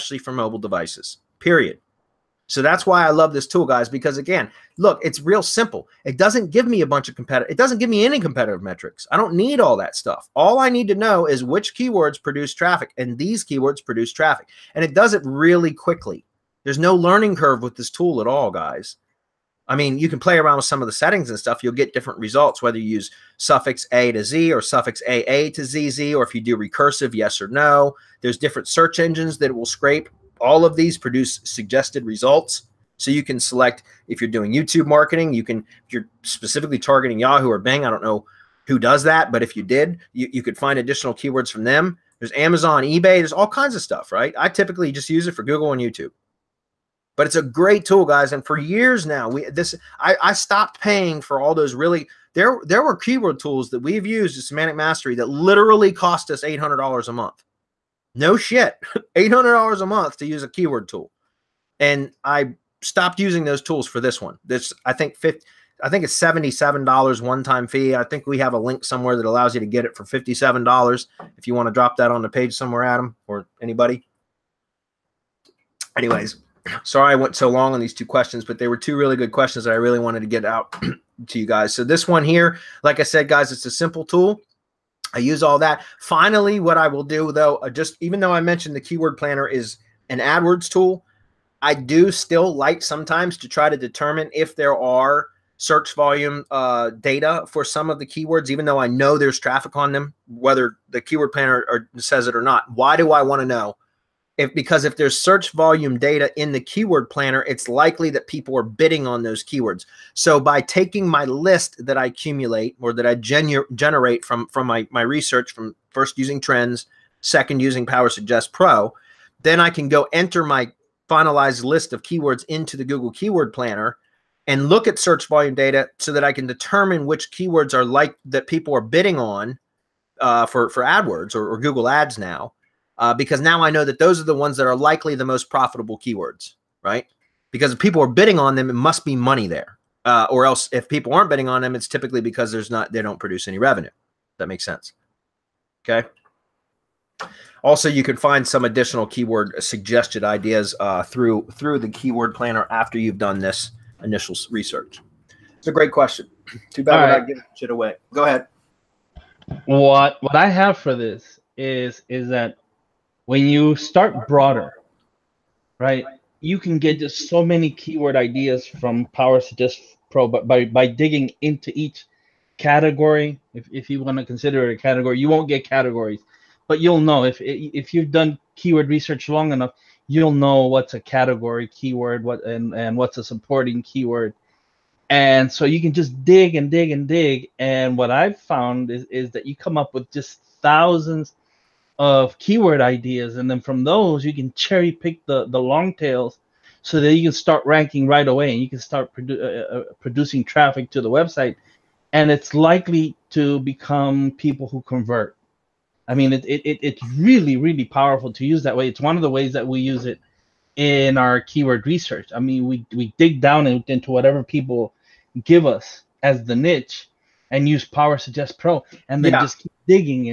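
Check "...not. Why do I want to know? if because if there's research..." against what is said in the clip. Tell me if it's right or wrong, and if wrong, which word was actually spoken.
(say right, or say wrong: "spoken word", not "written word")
wrong: "search", not "research".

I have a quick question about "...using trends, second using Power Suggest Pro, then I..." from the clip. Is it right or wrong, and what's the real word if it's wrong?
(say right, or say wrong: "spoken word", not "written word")
right.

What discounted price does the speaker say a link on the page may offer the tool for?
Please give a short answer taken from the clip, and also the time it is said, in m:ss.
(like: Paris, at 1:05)
$57, at 1:10.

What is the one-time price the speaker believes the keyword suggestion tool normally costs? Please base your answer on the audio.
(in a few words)
$77.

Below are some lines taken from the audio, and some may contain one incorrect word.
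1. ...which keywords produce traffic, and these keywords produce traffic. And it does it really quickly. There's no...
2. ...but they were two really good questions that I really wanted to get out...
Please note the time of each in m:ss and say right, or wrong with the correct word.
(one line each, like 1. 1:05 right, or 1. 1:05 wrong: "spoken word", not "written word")
1. 0:11 right
2. 1:18 right.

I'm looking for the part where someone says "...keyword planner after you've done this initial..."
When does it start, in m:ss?
2:31.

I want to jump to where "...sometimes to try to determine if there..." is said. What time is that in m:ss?
1:32.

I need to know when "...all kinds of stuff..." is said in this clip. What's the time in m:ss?
0:43.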